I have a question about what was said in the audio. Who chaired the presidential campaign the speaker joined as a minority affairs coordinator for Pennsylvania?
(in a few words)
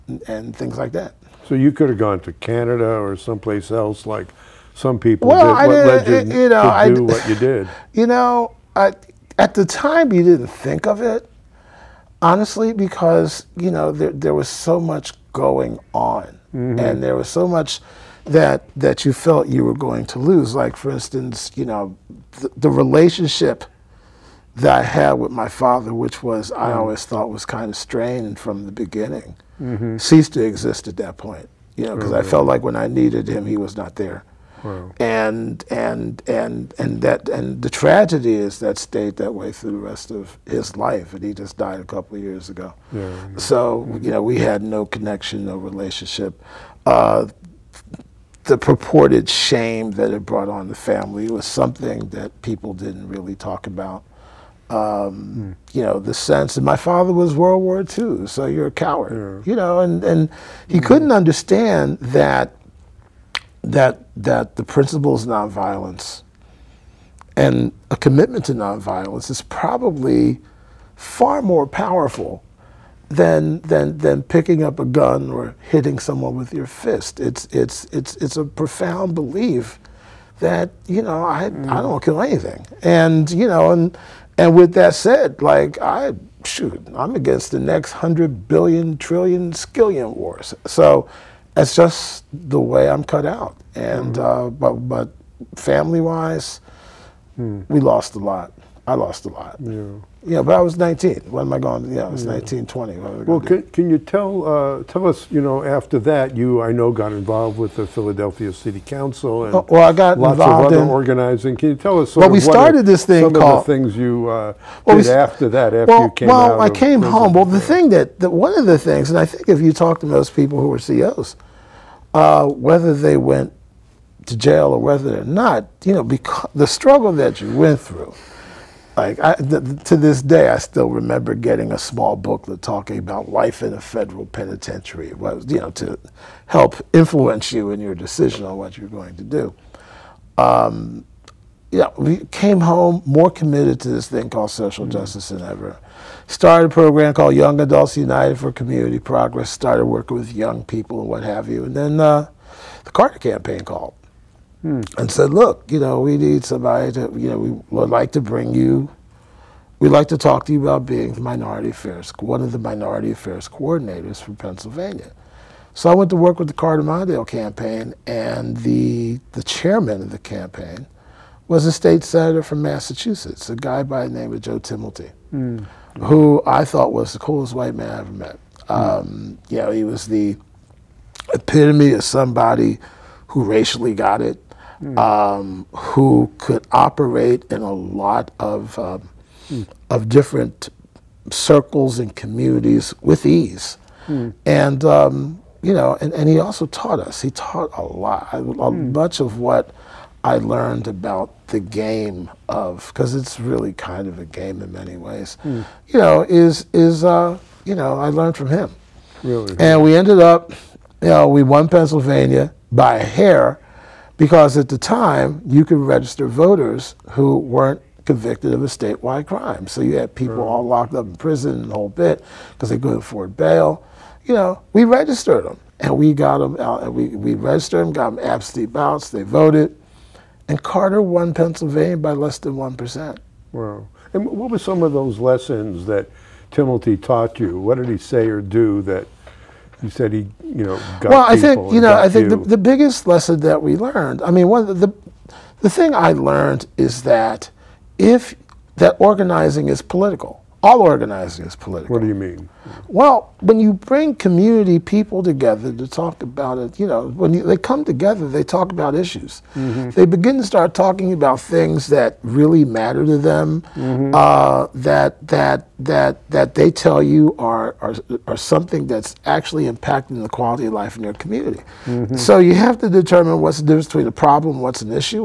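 Joe Timilty.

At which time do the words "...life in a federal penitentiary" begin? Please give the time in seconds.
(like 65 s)
133 s.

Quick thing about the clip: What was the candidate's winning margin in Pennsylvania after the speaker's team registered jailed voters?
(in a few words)
Less than 1%.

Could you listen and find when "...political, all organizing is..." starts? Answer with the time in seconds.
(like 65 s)
249 s.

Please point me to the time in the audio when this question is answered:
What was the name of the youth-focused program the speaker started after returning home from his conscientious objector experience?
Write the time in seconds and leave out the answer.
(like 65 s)
147 s.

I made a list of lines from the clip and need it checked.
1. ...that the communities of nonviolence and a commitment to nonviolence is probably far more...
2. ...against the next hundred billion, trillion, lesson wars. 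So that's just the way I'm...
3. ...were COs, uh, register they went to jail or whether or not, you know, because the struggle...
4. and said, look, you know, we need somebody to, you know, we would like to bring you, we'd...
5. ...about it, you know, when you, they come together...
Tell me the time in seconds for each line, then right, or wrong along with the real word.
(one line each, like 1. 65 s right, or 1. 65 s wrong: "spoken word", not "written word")
1. 64 s wrong: "principles", not "communities"
2. 87 s wrong: "skillion", not "lesson"
3. 120 s wrong: "whether", not "register"
4. 154 s right
5. 256 s right.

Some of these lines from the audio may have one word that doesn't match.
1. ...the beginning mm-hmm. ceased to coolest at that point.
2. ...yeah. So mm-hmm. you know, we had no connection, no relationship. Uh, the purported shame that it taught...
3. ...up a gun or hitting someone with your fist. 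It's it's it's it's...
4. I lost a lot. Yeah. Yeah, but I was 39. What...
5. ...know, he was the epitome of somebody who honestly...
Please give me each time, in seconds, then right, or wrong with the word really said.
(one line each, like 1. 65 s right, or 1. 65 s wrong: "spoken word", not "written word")
1. 28 s wrong: "exist", not "coolest"
2. 43 s wrong: "brought", not "taught"
3. 74 s right
4. 98 s wrong: "19", not "39"
5. 179 s wrong: "racially", not "honestly".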